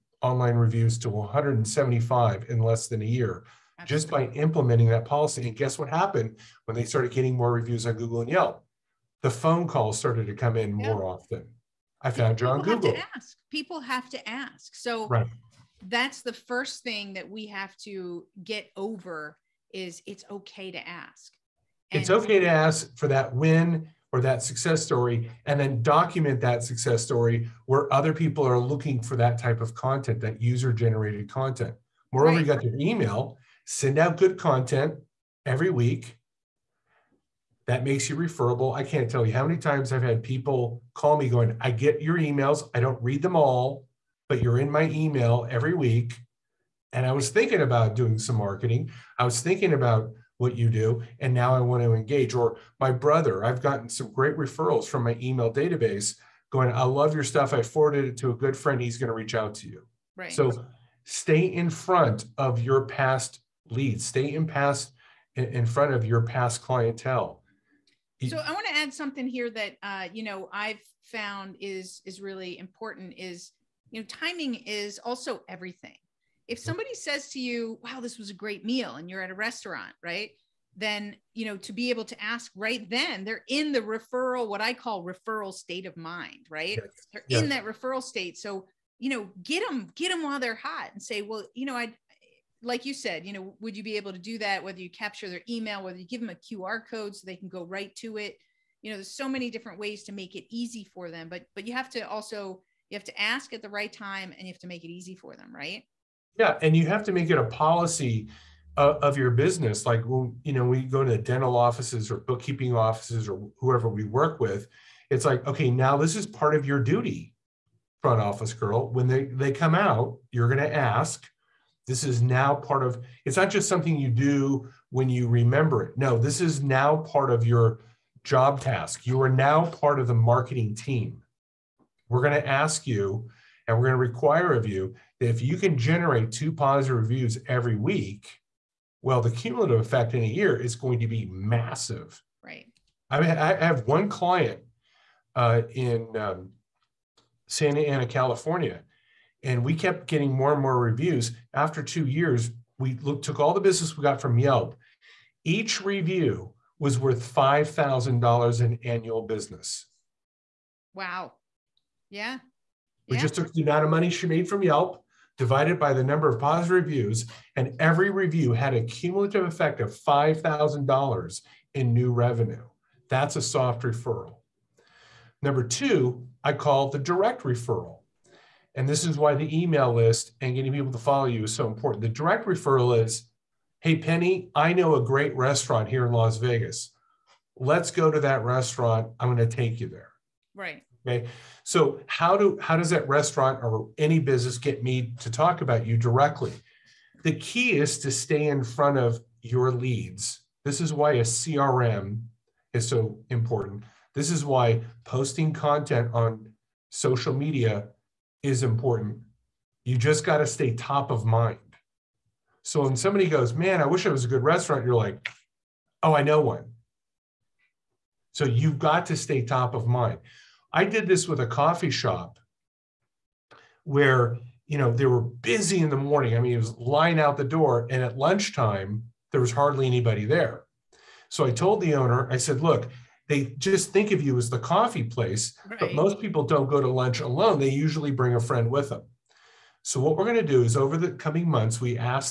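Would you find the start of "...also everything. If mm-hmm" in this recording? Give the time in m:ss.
1:14.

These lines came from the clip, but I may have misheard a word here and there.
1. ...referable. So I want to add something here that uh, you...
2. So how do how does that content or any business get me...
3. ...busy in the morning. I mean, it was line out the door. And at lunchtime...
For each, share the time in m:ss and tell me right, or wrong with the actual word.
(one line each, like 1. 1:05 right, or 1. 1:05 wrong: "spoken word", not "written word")
1. 1:06 wrong: "clientele", not "referable"
2. 3:11 wrong: "restaurant", not "content"
3. 3:45 right.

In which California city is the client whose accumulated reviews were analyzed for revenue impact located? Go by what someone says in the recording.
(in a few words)
Santa Ana.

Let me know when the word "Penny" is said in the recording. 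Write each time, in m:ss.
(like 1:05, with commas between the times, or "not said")
3:03.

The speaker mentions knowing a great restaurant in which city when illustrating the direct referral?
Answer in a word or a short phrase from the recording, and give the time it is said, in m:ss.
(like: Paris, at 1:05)
Las Vegas, at 3:06.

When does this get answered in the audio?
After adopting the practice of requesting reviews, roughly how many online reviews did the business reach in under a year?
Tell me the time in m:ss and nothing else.
0:01.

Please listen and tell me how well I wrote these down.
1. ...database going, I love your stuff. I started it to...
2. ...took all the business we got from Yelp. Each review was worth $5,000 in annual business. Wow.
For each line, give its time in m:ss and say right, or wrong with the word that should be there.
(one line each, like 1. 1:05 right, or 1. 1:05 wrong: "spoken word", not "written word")
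1. 0:55 wrong: "forwarded", not "started"
2. 2:33 right.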